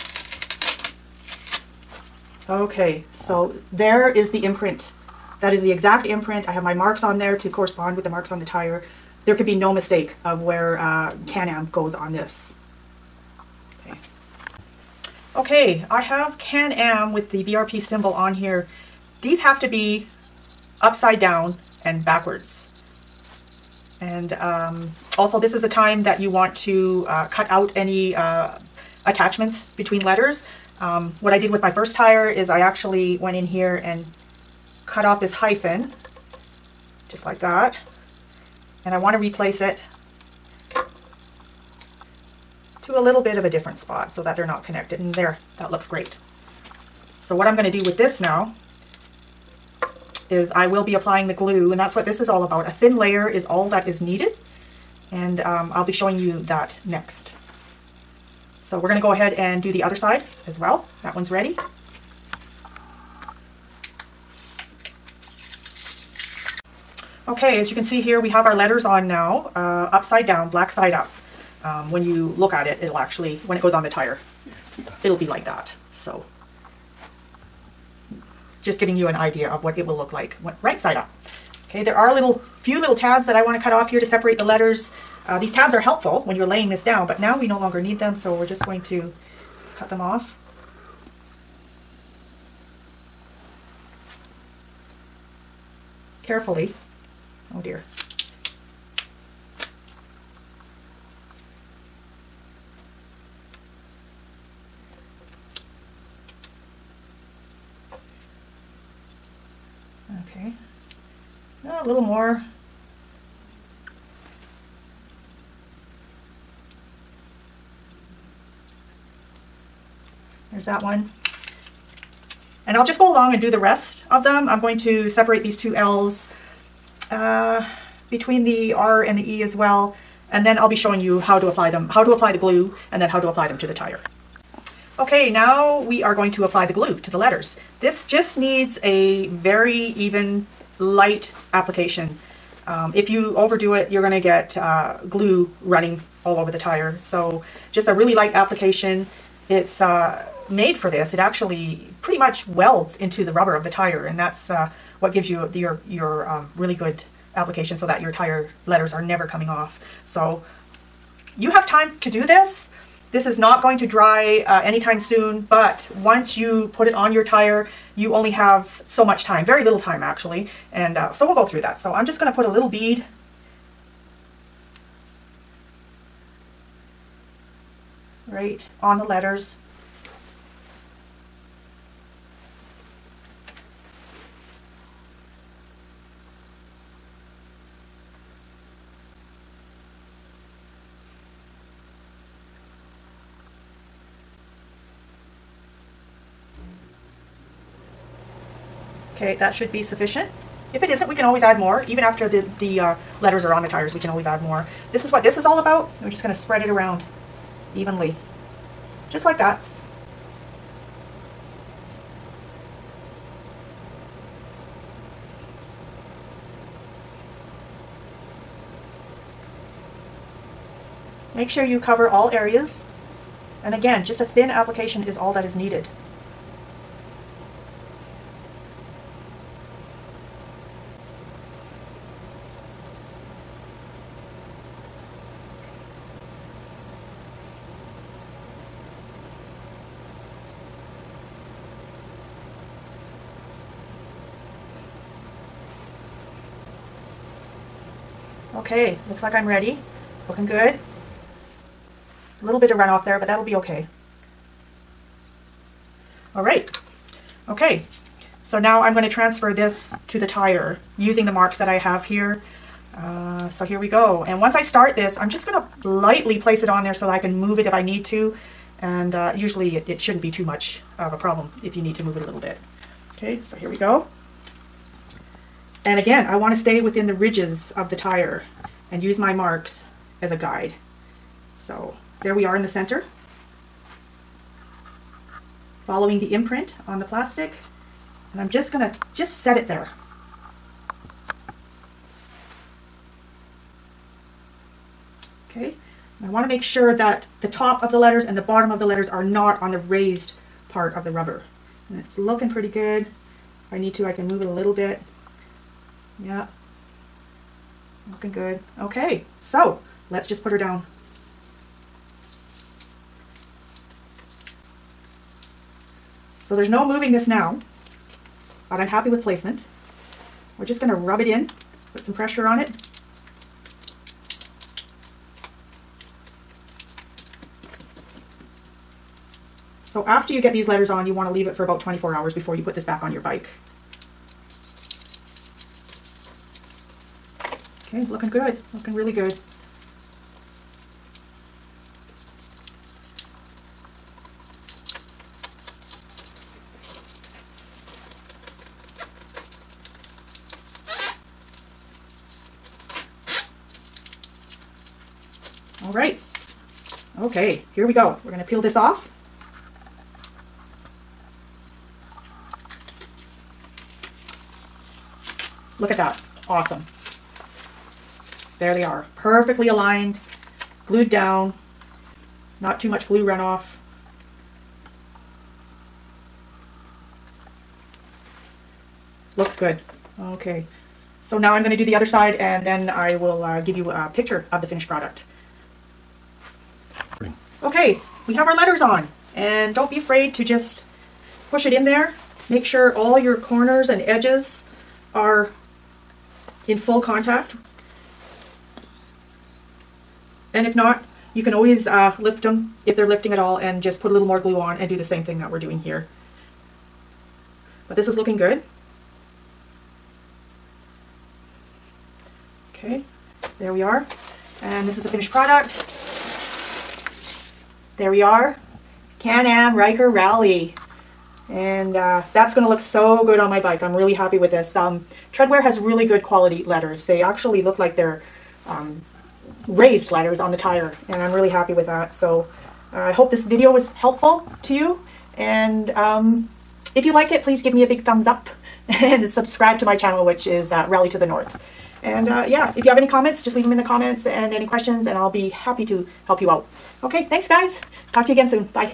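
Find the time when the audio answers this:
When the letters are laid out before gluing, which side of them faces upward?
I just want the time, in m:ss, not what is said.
1:10.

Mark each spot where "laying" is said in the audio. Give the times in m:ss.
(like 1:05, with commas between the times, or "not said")
1:26.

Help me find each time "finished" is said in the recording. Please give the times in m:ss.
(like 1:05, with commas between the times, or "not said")
6:24, 6:55.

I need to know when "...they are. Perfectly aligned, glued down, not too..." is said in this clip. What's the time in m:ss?
6:08.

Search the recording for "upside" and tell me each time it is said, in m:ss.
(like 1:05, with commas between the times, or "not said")
0:20, 1:09.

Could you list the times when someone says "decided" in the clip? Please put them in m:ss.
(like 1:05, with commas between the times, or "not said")
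not said.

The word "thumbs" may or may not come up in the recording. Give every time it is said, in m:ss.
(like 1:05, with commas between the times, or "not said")
7:18.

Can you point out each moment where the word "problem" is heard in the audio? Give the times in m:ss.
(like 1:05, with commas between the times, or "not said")
4:31.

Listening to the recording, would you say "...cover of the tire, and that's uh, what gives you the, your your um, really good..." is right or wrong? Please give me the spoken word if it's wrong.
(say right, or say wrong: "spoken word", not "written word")
wrong: "rubber", not "cover".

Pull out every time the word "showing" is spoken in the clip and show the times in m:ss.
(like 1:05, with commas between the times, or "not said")
0:55, 2:10.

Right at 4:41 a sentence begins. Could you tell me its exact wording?
So there we are in the center.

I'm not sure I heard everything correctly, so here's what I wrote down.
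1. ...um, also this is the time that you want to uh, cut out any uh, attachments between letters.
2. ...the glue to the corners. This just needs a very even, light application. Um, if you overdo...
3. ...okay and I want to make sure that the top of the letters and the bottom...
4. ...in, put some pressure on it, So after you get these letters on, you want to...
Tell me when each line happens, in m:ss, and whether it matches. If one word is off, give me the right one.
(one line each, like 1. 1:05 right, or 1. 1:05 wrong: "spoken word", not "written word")
1. 0:24 right
2. 2:16 wrong: "letters", not "corners"
3. 4:55 right
4. 5:21 right.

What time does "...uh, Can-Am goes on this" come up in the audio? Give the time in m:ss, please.
0:10.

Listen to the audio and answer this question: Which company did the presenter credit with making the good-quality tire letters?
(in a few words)
TredWear.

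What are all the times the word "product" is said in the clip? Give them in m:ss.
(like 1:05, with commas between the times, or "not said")
6:24, 6:55.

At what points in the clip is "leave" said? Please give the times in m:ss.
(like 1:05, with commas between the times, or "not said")
5:31, 7:23.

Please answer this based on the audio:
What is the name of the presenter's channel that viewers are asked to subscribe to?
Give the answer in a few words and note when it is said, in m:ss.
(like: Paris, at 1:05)
Rally to the North, at 7:20.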